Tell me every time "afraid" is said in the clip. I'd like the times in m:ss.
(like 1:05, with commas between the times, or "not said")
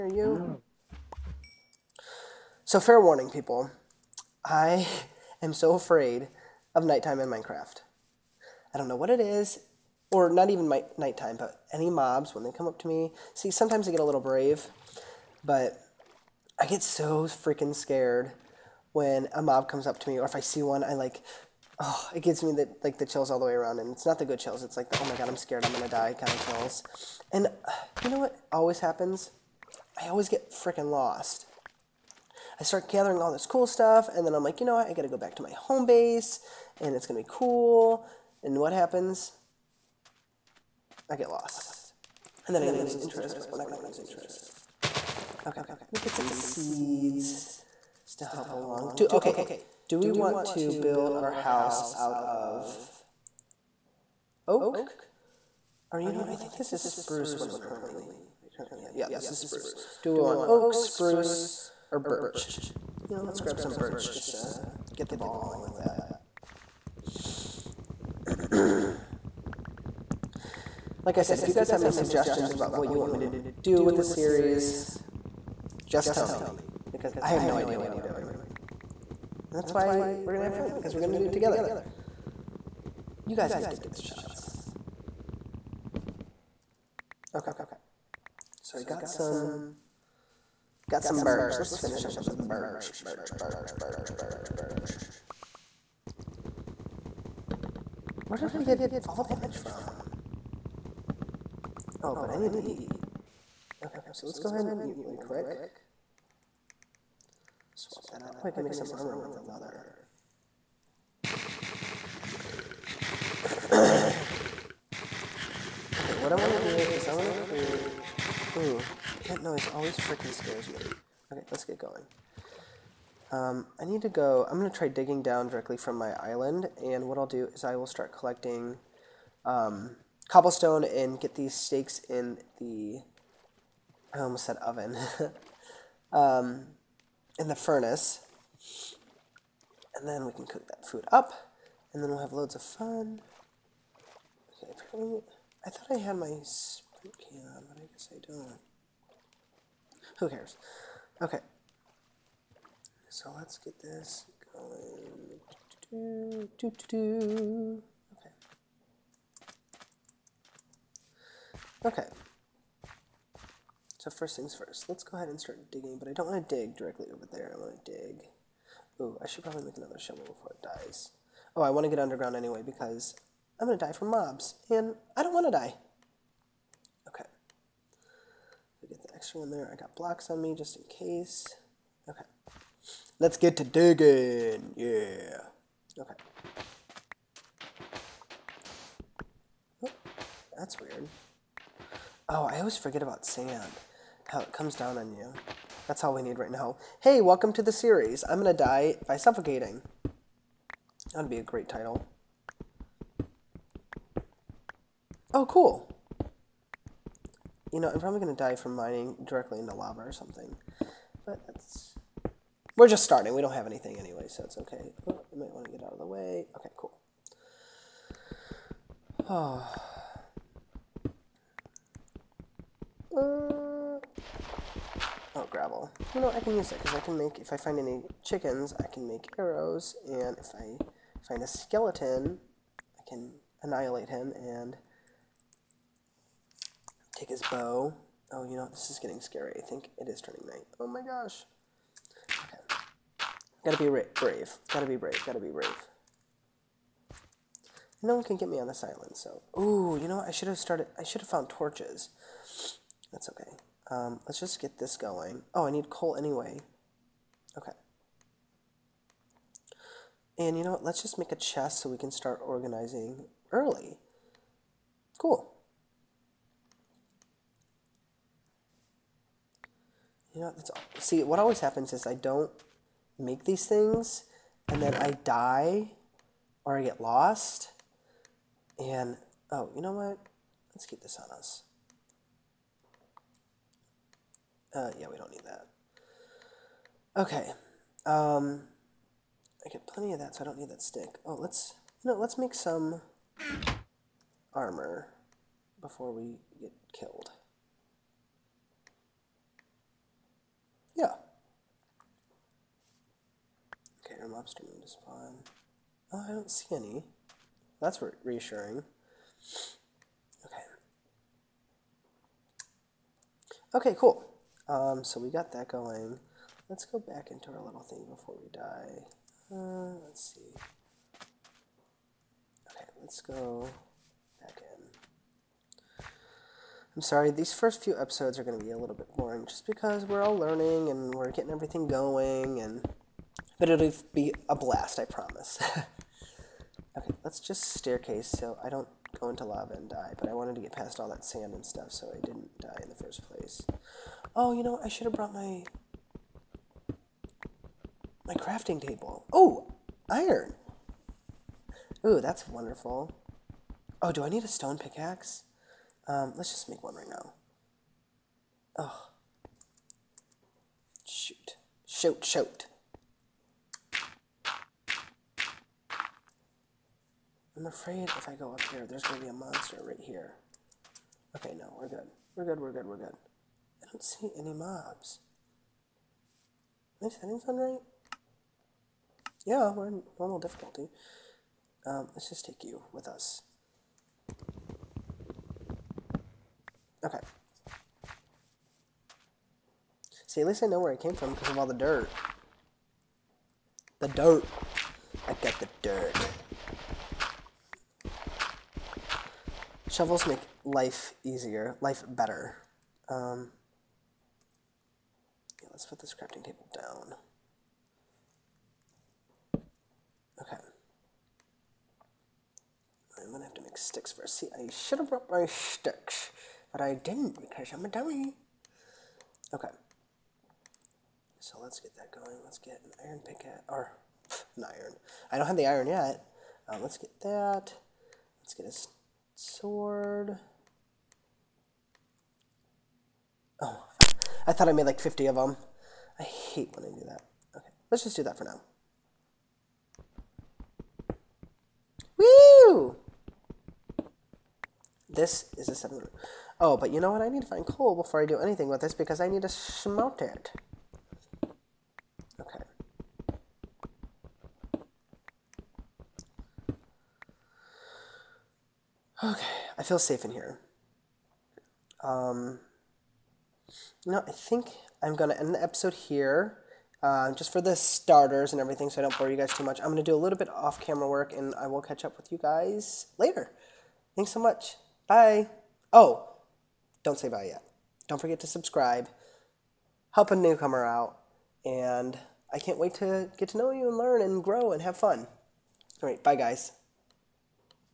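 0:05, 6:07.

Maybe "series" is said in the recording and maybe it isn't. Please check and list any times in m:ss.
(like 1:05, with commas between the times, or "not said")
1:14, 3:17.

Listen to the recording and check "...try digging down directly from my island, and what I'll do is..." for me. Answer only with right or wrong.
right.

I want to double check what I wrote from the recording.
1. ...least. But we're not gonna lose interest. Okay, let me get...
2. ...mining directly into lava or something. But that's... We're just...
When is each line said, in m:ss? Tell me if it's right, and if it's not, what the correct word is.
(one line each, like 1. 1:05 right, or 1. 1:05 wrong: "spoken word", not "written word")
1. 0:43 wrong: "interest", not "least"
2. 3:28 right.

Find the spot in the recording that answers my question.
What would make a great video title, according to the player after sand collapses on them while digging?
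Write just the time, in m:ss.
3:18.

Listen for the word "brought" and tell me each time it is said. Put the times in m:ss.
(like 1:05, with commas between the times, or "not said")
5:45, 6:55.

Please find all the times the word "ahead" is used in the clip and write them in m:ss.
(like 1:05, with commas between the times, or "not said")
1:44, 2:45.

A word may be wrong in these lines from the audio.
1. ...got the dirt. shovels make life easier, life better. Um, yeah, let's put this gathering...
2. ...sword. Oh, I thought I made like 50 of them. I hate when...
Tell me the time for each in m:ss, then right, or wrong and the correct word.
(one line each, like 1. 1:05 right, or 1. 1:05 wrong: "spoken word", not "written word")
1. 6:35 wrong: "crafting", not "gathering"
2. 7:09 right.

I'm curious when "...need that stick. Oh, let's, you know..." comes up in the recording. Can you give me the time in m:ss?
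4:50.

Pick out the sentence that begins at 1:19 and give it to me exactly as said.
That's why we're going to have fun because we're going to do it together.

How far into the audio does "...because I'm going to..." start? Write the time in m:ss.
2:52.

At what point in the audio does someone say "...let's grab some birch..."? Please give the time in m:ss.
1:03.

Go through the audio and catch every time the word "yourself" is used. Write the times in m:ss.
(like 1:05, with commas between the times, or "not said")
not said.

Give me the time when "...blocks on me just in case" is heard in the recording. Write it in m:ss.
2:59.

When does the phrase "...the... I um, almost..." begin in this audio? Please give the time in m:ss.
2:12.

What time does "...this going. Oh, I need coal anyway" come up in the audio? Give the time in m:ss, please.
4:14.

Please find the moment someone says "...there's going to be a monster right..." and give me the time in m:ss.
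6:08.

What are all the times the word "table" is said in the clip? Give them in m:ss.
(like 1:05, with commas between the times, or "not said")
5:48, 6:46.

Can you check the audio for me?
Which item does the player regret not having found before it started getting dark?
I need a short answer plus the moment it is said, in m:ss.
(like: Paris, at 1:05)
torches, at 4:11.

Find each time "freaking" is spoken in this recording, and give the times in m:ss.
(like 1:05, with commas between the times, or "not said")
0:17, 0:30, 1:59.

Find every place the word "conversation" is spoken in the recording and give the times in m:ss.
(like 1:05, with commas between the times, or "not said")
not said.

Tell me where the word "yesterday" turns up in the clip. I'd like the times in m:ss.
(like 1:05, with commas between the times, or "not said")
not said.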